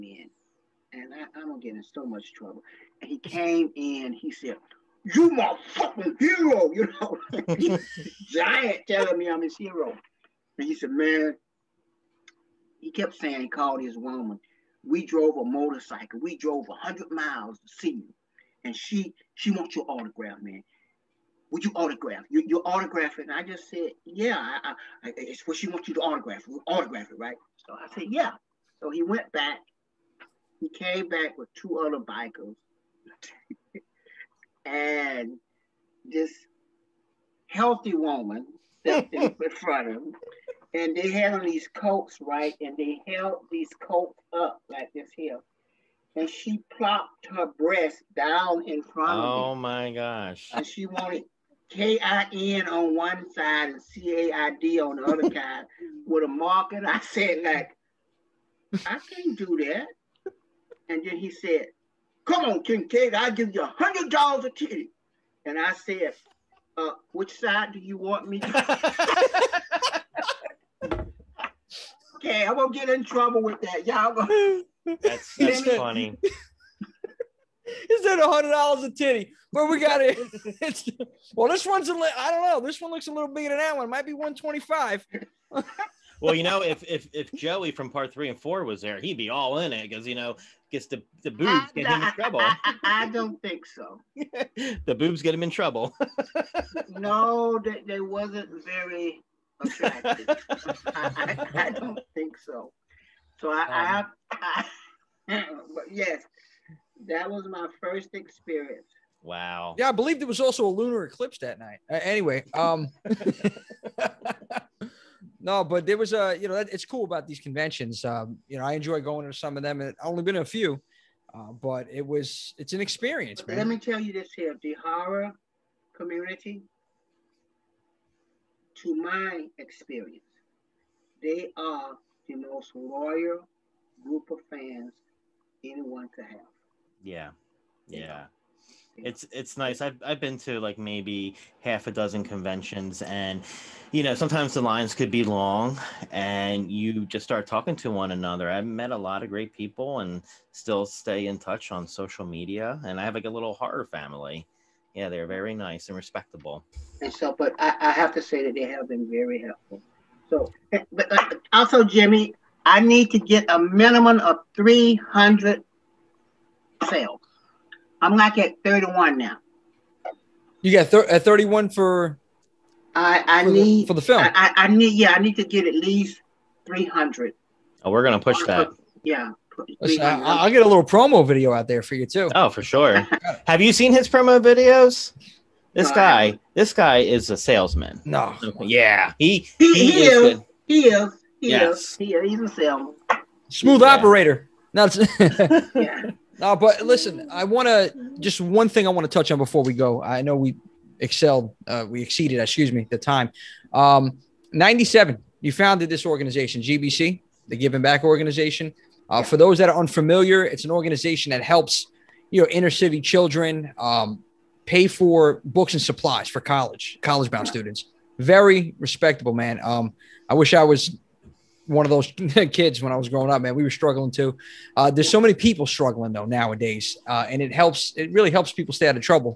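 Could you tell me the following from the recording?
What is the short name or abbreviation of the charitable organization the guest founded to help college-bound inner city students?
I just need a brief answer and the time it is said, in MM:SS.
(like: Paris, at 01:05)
GBC, at 03:26.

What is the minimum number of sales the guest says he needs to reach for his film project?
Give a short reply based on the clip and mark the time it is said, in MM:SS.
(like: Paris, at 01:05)
300, at 02:43.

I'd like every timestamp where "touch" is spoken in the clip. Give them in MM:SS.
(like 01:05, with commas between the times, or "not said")
02:31, 03:19.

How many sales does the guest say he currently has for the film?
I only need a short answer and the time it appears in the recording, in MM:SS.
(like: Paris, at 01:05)
31, at 02:48.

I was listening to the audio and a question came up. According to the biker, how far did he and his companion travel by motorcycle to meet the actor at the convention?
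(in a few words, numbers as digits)
100 miles.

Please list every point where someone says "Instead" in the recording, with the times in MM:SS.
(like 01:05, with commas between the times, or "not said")
01:17.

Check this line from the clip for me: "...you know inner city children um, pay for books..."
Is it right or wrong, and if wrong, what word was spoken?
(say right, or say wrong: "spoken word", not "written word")
right.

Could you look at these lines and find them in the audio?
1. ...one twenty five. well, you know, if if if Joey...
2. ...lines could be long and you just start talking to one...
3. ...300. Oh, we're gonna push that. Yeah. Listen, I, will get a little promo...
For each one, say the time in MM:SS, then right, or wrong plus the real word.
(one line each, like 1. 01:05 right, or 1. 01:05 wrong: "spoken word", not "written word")
1. 01:24 right
2. 02:24 right
3. 02:56 right.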